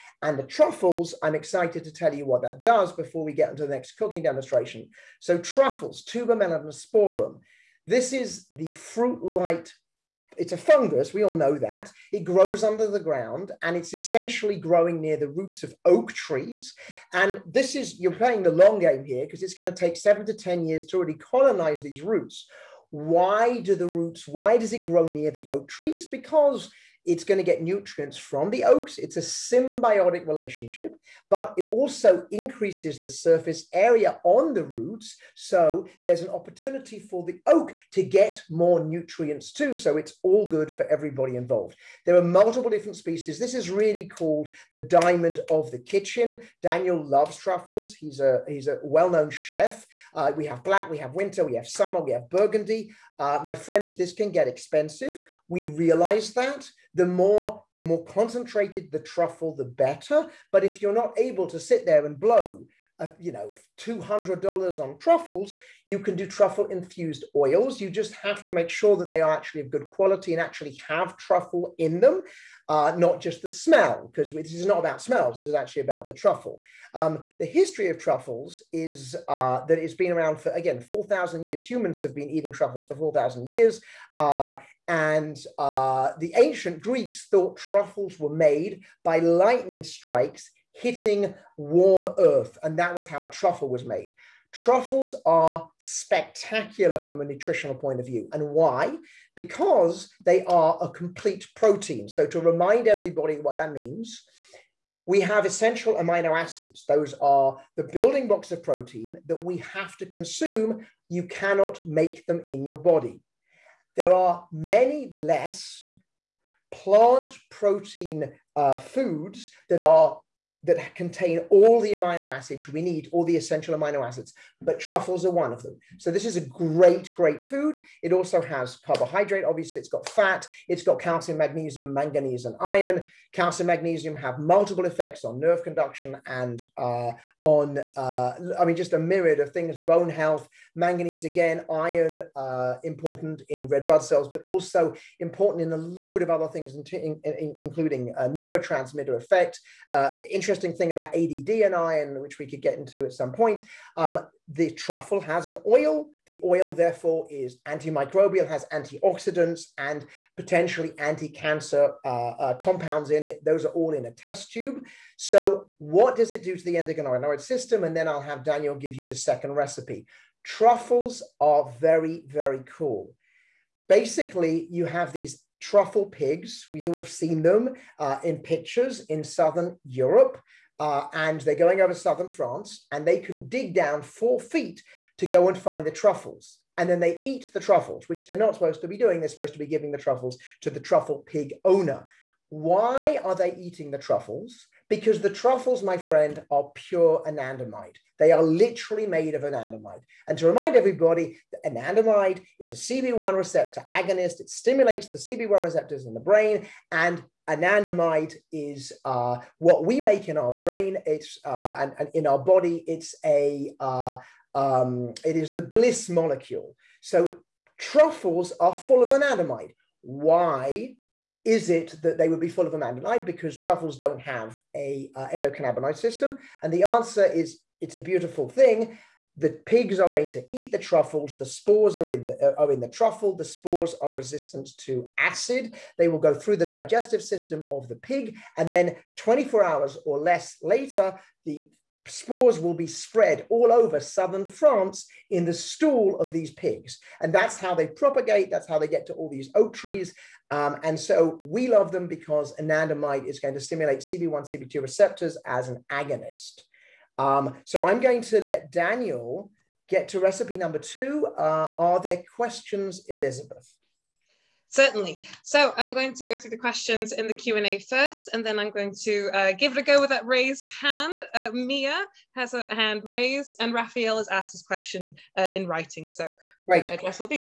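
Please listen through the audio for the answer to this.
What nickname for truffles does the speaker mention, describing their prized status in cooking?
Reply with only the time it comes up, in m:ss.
0:44.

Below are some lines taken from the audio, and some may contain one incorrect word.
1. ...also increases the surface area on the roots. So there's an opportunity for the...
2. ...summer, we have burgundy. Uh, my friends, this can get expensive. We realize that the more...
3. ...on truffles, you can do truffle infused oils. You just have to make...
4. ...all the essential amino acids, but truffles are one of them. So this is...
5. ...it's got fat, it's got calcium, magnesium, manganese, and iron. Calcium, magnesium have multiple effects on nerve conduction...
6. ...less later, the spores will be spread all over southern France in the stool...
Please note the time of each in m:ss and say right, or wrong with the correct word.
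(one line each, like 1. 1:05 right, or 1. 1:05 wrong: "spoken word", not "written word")
1. 0:31 right
2. 0:51 right
3. 1:04 right
4. 2:03 right
5. 2:09 right
6. 4:00 right.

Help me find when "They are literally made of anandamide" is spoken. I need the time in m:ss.
3:18.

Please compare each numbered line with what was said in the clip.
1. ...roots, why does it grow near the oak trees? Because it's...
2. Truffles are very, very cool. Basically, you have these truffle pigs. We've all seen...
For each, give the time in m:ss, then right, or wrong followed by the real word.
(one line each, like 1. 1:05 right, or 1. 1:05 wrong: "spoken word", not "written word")
1. 0:23 right
2. 2:50 right.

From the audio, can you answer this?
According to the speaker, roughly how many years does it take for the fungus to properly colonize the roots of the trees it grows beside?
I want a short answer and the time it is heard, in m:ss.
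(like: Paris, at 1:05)
7 to 10 years, at 0:19.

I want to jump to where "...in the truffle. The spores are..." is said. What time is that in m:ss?
3:52.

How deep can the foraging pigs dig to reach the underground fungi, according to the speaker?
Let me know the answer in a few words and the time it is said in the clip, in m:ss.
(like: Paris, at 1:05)
4 feet, at 3:04.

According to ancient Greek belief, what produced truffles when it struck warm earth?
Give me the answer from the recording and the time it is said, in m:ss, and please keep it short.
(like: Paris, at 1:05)
Lightning strikes, at 1:29.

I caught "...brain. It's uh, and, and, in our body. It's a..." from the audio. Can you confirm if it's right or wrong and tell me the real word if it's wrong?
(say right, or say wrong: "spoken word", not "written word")
right.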